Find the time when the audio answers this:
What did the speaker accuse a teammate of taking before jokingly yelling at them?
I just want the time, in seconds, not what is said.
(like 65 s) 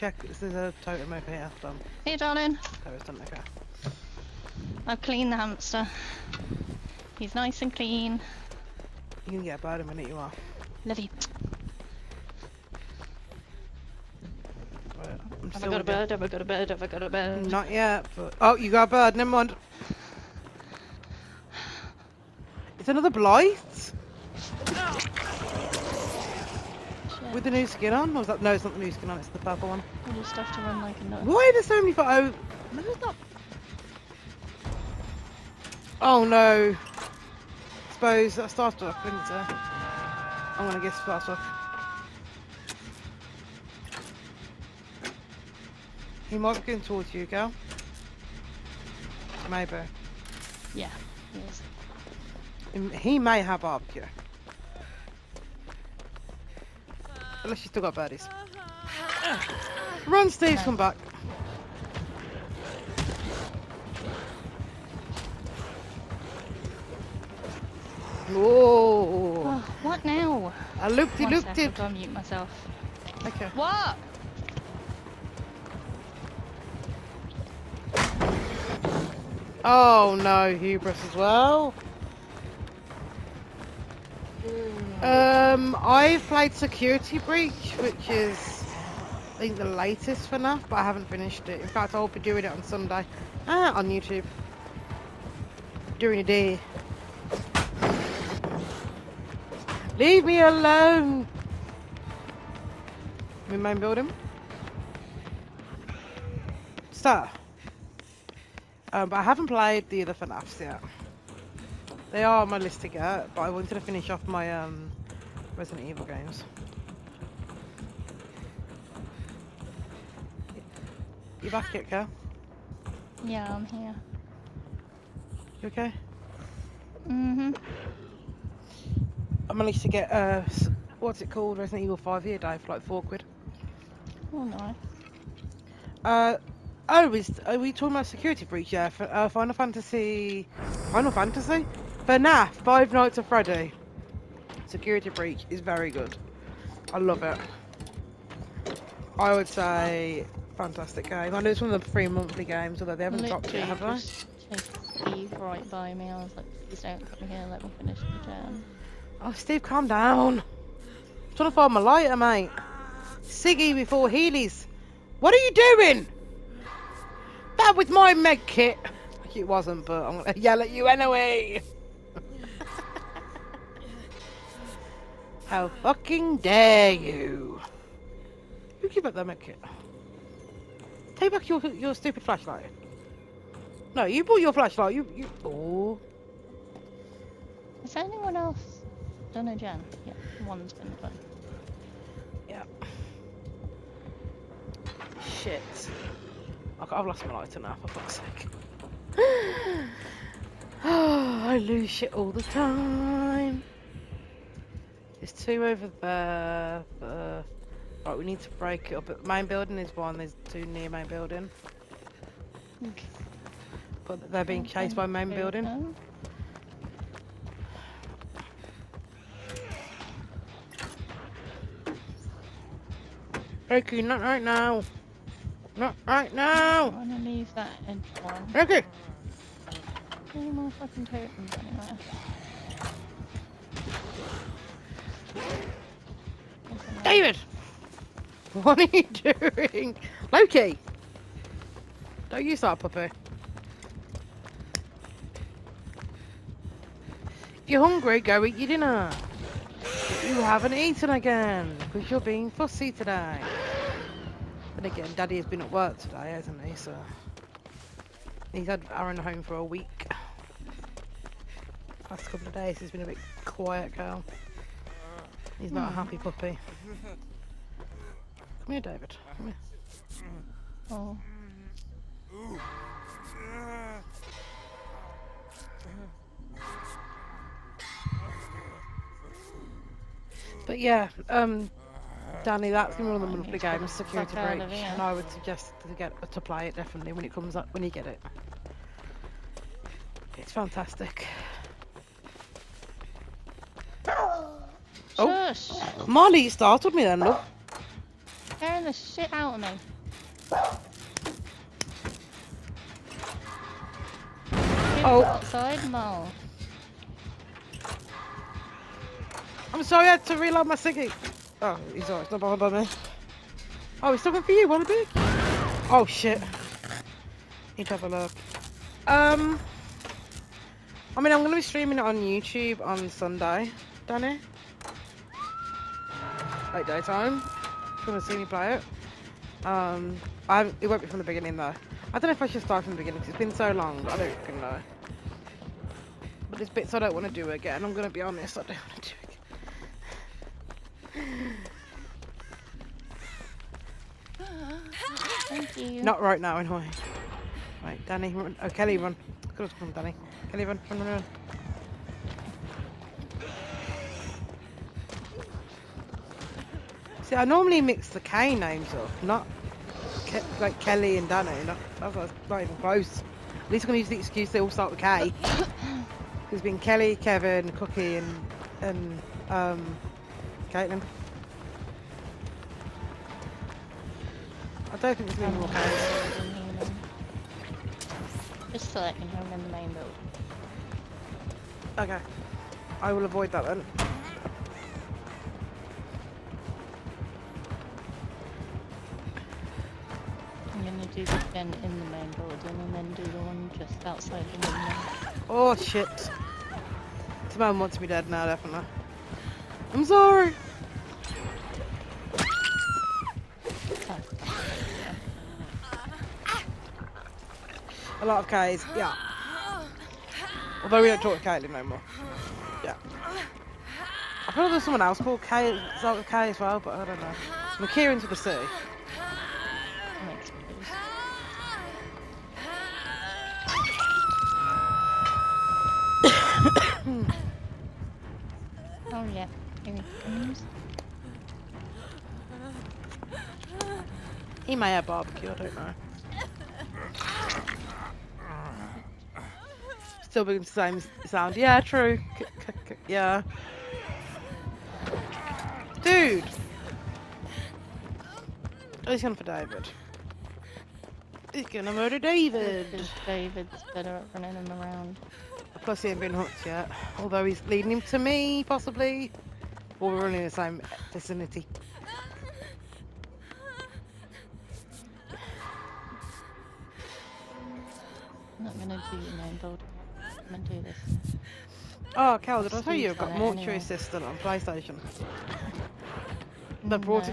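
168 s.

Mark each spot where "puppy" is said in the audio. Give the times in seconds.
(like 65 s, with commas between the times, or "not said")
242 s, 266 s.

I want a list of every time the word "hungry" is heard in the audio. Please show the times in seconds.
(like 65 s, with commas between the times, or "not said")
247 s.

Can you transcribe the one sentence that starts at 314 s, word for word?
Oh, he's talking for you, Wanna be?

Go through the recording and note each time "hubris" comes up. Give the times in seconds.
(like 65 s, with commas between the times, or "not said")
80 s.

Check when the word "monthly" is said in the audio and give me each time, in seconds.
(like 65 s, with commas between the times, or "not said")
152 s, 283 s.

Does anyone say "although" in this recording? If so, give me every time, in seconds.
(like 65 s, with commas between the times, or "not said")
152 s, 410 s, 457 s.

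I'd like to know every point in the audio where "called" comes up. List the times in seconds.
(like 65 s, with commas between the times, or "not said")
131 s, 415 s.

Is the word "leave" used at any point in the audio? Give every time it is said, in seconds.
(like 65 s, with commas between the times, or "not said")
99 s, 227 s.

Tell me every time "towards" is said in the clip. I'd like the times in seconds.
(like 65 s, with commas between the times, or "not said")
46 s.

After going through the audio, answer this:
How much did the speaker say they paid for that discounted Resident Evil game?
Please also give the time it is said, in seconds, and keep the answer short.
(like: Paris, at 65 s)
4 quid, at 132 s.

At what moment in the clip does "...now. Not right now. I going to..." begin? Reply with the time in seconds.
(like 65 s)
224 s.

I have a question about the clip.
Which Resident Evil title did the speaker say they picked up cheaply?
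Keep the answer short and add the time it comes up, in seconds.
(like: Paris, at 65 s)
Resident Evil 5, at 131 s.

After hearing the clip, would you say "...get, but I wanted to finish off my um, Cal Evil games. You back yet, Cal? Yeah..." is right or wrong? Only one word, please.
wrong.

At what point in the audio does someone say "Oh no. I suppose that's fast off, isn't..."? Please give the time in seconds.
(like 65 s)
35 s.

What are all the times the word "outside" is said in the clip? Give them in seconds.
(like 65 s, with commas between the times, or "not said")
305 s, 394 s.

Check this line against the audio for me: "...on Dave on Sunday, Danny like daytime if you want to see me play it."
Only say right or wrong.
wrong.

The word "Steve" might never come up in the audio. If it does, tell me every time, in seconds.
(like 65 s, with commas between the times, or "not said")
60 s, 155 s, 159 s.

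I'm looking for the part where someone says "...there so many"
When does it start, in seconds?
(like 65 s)
31 s.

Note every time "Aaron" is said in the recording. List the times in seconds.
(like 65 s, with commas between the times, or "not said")
258 s.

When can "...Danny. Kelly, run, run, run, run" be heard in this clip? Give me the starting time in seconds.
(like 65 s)
349 s.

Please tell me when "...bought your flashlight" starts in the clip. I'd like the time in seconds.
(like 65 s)
184 s.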